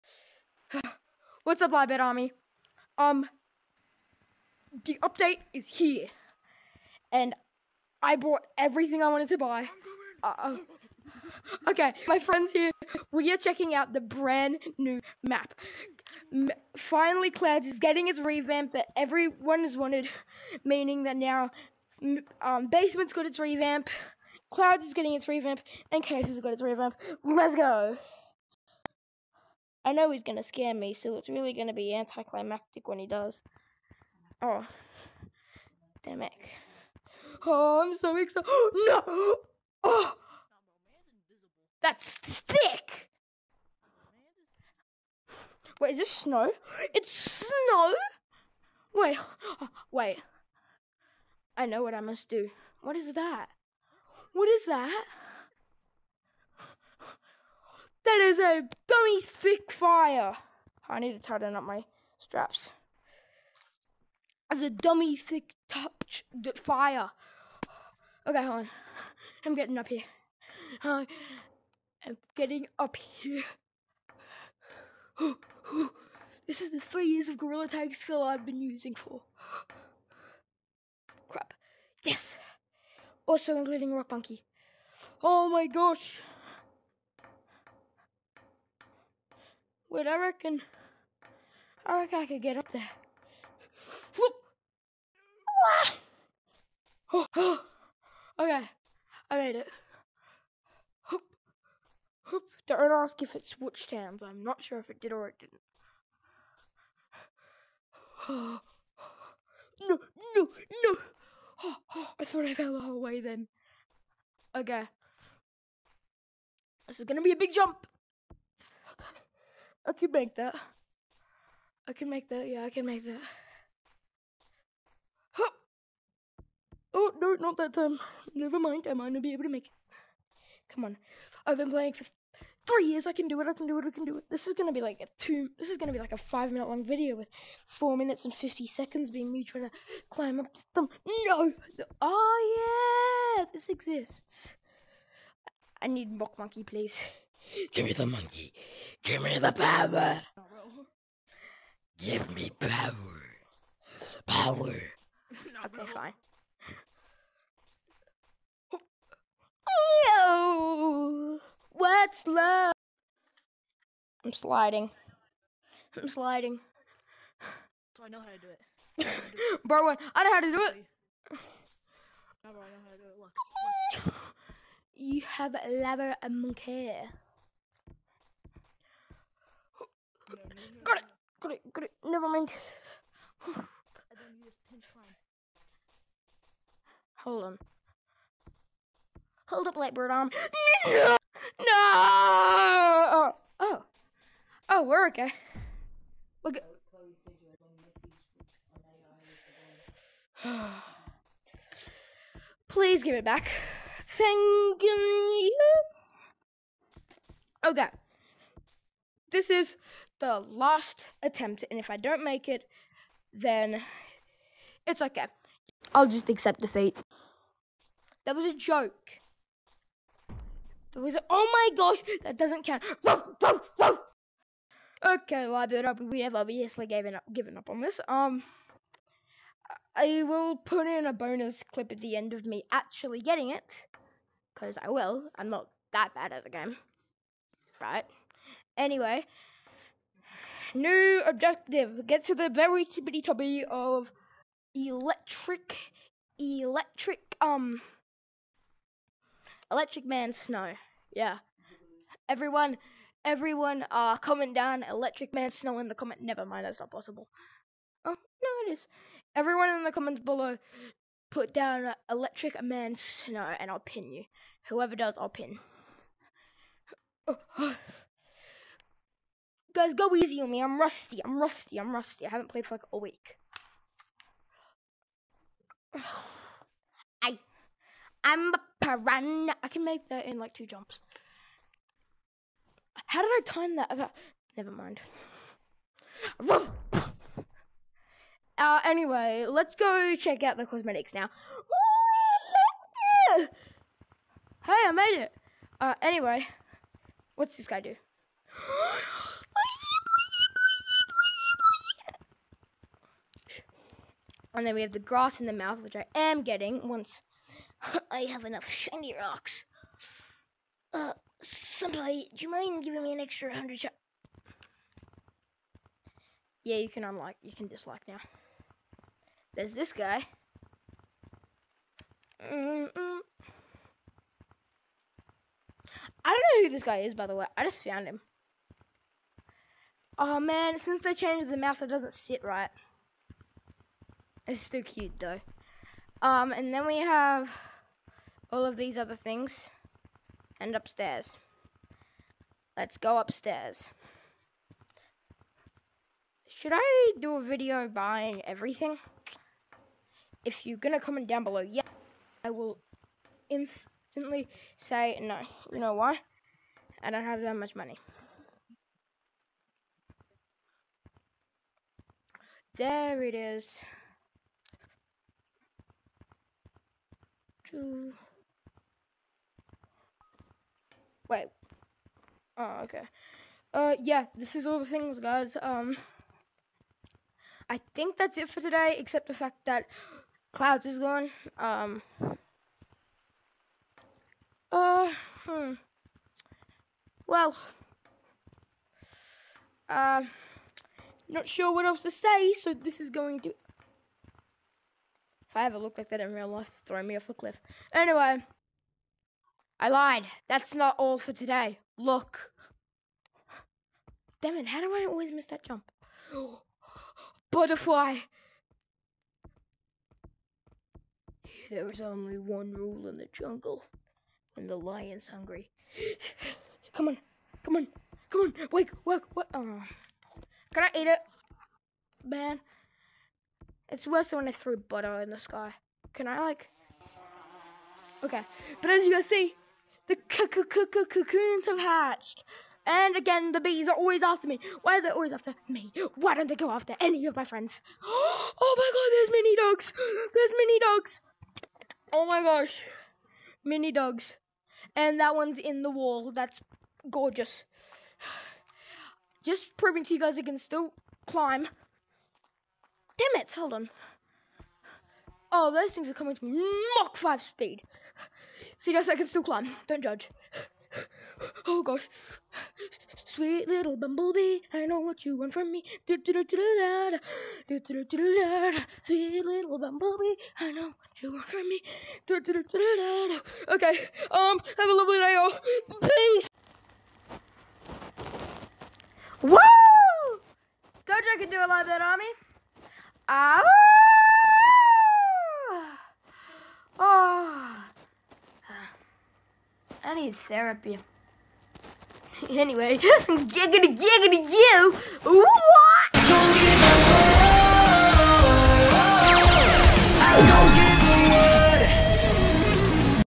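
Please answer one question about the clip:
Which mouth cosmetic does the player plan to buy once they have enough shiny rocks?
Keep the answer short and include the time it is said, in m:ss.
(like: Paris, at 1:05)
grass in the mouth, at 5:04.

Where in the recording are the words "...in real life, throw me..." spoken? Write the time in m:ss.
6:36.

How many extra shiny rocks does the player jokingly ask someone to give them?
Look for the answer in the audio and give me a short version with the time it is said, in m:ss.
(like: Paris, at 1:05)
100, at 5:13.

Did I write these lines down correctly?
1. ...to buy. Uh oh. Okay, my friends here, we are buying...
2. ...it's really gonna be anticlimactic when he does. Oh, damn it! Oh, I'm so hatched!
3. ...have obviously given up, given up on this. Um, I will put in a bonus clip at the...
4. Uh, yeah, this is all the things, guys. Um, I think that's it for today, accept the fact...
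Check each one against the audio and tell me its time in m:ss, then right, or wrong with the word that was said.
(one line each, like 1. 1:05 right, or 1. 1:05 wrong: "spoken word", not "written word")
1. 0:09 wrong: "checking", not "buying"
2. 0:31 wrong: "excited", not "hatched"
3. 3:46 right
4. 6:13 wrong: "except", not "accept".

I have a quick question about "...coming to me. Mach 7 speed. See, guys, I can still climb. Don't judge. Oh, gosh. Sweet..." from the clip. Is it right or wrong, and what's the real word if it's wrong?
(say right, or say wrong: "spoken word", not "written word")
wrong: "5", not "7".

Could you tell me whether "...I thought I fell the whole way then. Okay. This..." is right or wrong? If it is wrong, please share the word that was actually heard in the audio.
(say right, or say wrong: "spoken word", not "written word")
right.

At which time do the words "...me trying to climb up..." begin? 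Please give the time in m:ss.
2:19.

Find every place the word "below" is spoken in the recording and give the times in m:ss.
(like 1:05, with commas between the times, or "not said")
4:20, 5:51.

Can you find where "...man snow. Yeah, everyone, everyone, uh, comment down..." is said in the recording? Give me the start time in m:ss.
4:10.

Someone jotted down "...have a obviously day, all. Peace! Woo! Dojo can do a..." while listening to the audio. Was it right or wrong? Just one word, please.
wrong.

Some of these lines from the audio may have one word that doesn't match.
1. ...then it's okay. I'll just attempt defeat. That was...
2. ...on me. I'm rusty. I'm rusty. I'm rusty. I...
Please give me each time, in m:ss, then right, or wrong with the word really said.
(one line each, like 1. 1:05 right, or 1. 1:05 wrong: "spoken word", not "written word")
1. 3:33 wrong: "accept", not "attempt"
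2. 4:30 right.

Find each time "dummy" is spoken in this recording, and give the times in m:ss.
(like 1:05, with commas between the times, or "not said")
0:58, 1:04.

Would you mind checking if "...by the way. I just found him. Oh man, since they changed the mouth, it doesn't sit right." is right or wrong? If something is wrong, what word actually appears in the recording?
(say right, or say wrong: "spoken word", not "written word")
right.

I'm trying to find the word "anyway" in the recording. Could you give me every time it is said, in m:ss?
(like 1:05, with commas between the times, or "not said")
3:58, 4:48, 4:56, 6:37, 8:12.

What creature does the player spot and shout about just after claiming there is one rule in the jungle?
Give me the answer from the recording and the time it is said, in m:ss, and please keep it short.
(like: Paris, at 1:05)
Butterfly, at 6:47.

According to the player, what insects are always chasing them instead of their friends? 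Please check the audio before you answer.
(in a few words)
bees.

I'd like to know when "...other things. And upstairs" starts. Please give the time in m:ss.
5:38.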